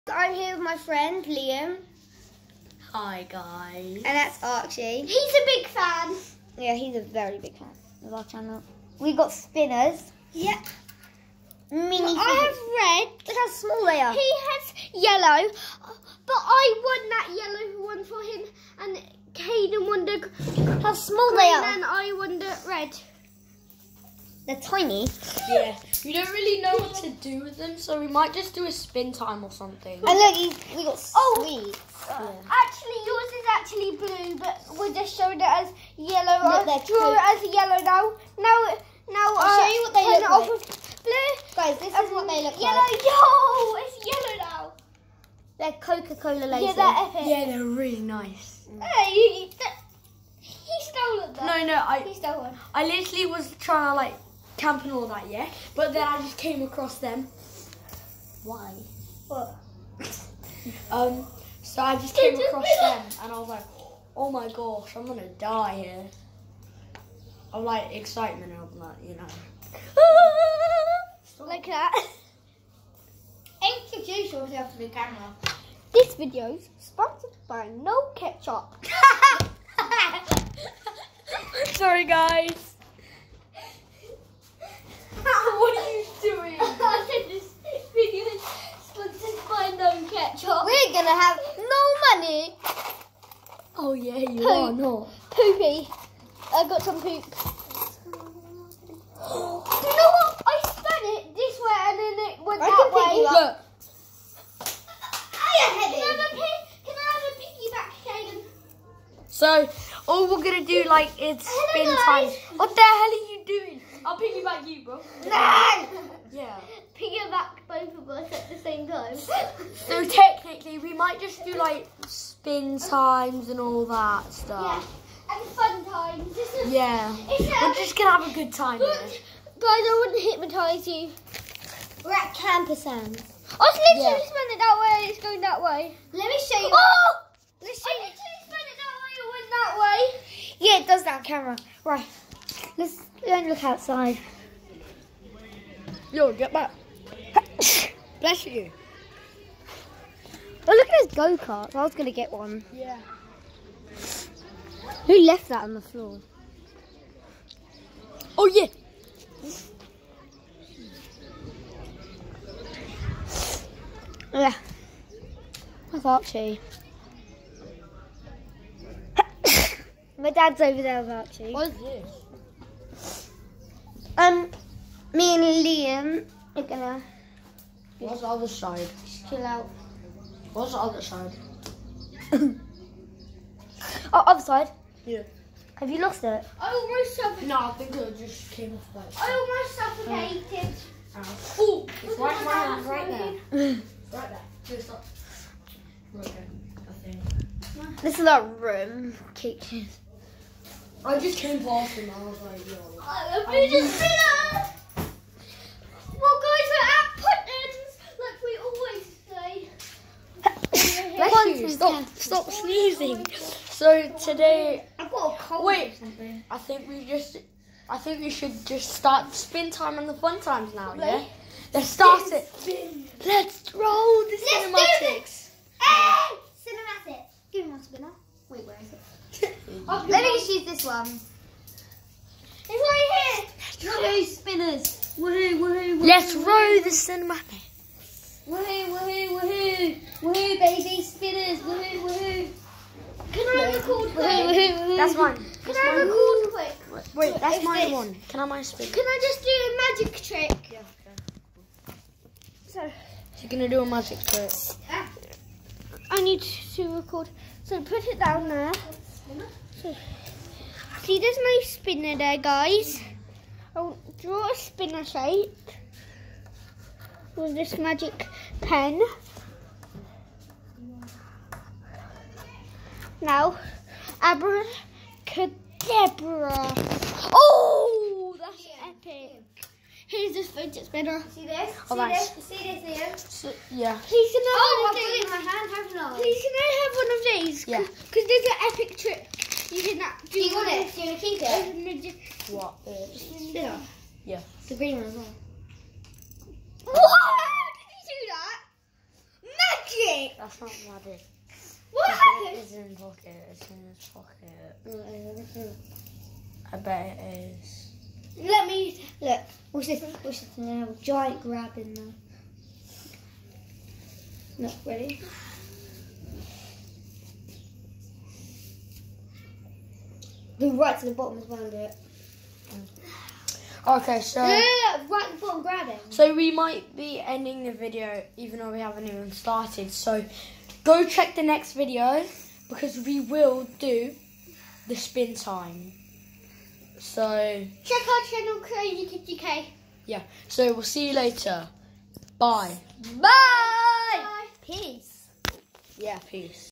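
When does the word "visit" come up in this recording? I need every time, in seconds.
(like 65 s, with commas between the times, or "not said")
not said.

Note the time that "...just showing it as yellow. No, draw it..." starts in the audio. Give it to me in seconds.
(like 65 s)
34 s.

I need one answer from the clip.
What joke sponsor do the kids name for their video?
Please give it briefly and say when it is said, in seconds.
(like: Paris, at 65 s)
No Ketchup, at 77 s.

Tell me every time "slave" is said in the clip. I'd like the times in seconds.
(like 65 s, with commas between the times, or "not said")
not said.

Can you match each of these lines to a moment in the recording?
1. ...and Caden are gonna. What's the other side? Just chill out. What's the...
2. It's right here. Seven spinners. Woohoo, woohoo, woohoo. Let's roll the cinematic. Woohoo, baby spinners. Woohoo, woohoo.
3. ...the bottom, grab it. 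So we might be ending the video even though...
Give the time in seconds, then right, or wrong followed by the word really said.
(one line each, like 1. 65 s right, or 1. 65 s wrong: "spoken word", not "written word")
1. 175 s wrong: "Liam", not "Caden"
2. 232 s wrong: "Two", not "Seven"
3. 325 s right.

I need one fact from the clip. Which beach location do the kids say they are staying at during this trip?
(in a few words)
Camber Sands.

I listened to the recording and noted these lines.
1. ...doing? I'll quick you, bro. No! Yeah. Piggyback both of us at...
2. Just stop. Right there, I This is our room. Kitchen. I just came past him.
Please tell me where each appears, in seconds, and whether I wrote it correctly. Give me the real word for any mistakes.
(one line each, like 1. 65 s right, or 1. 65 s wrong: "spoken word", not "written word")
1. 113 s wrong: "piggyback", not "quick"
2. 194 s right.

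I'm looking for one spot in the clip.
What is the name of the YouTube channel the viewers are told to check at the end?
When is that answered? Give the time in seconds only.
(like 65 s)
338 s.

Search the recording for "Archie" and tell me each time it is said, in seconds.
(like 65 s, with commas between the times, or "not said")
4 s, 166 s, 171 s.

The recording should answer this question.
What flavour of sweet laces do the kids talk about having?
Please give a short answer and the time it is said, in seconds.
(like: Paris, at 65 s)
Coca-Cola, at 45 s.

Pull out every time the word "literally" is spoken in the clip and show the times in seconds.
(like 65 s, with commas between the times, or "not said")
52 s, 133 s, 138 s.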